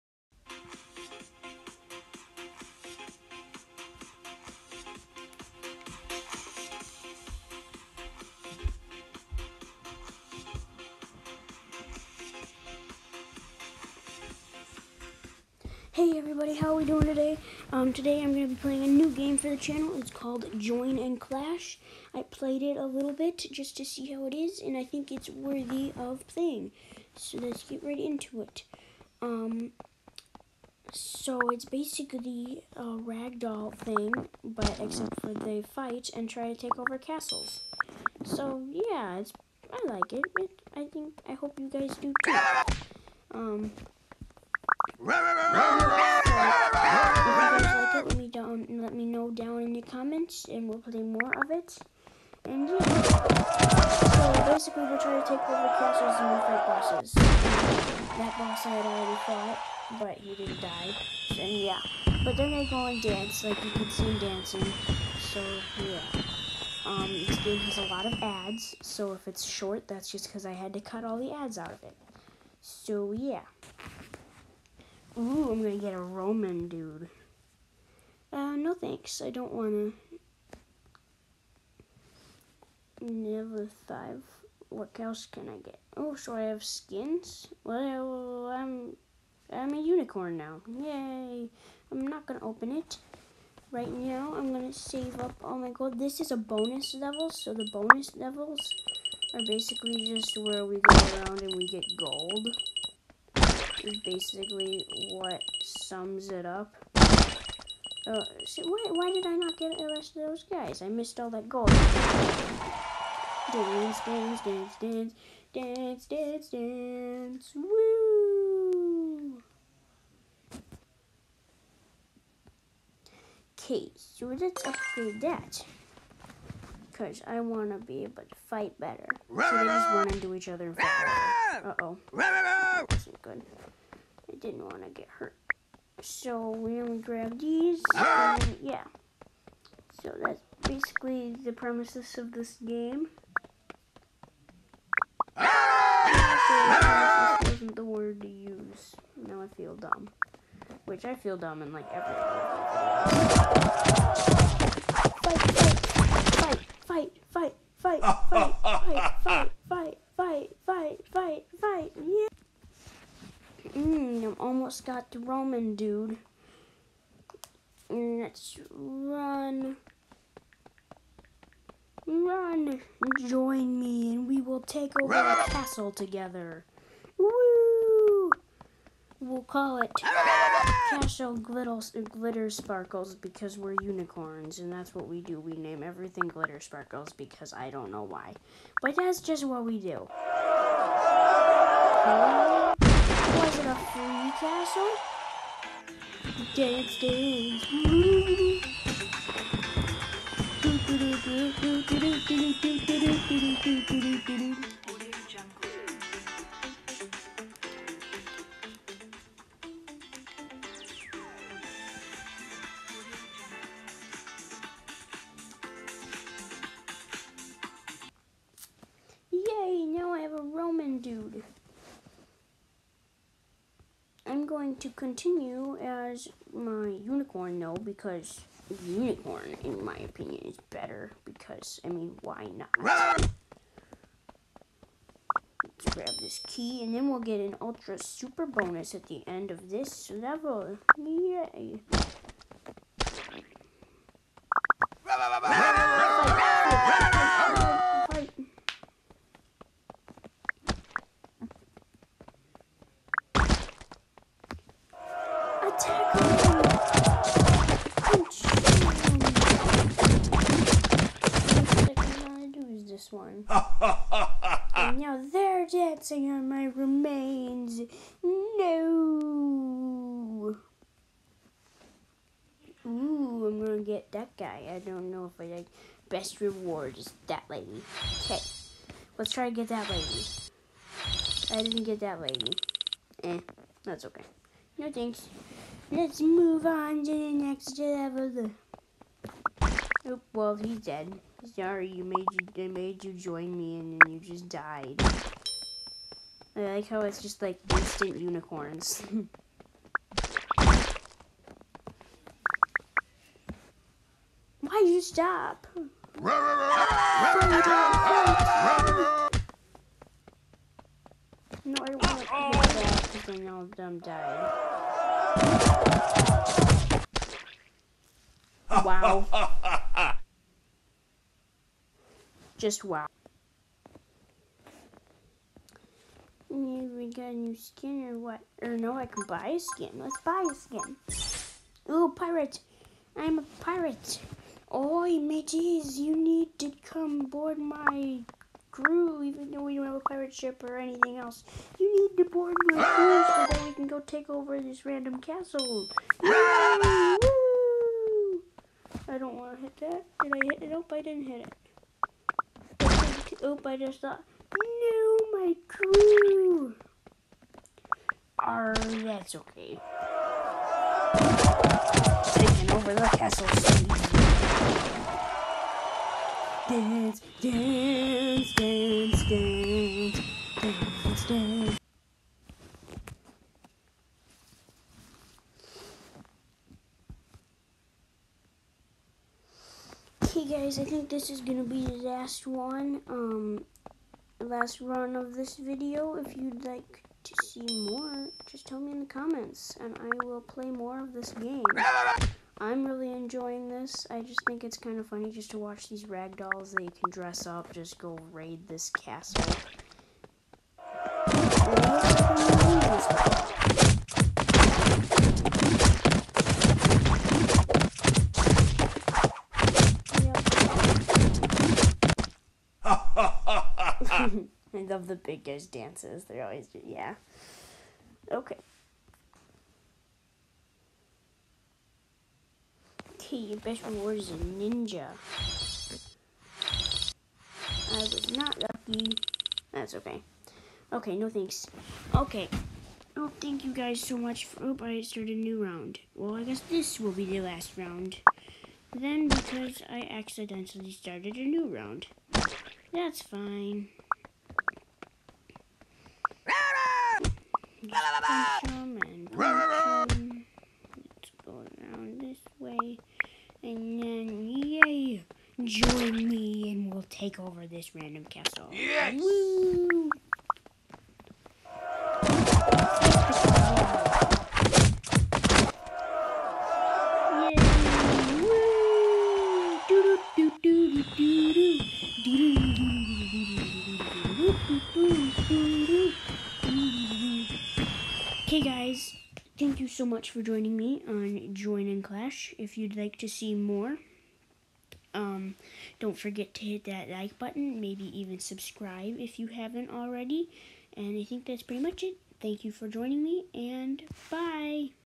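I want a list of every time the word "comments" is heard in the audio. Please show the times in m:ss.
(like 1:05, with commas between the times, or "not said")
0:49, 6:29.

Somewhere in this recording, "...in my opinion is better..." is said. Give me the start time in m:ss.
3:49.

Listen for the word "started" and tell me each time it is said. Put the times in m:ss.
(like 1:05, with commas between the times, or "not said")
7:15, 7:20.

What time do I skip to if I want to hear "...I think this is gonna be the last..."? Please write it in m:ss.
6:20.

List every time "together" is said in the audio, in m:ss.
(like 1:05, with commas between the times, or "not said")
2:55.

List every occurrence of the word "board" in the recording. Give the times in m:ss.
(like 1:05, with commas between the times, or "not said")
5:37, 5:42.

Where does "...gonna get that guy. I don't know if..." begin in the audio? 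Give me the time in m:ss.
4:33.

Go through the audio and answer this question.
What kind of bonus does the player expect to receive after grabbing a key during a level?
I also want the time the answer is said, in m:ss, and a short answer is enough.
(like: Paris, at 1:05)
ultra super bonus, at 3:57.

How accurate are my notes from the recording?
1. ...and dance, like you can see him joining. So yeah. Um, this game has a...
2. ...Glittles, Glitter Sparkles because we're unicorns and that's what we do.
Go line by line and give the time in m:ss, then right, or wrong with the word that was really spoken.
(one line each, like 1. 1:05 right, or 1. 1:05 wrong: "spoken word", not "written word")
1. 1:02 wrong: "dancing", not "joining"
2. 3:01 right.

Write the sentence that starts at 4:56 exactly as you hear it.
I like how it's just like instant unicorns.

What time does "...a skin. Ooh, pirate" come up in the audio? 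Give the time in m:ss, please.
5:30.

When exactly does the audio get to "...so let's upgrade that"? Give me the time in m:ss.
2:03.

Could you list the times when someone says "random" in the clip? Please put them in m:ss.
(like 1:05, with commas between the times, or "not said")
5:44, 7:37.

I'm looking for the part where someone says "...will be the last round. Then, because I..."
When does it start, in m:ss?
7:17.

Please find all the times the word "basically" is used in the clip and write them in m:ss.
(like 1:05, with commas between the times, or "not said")
0:31, 0:54, 1:39, 1:43, 2:20.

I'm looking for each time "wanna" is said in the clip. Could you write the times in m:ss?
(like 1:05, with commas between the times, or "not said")
1:19, 2:07, 2:14.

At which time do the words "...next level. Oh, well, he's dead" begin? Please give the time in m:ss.
4:47.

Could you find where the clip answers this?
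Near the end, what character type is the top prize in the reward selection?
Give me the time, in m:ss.
7:04.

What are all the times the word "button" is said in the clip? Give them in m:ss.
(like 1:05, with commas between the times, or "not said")
8:07.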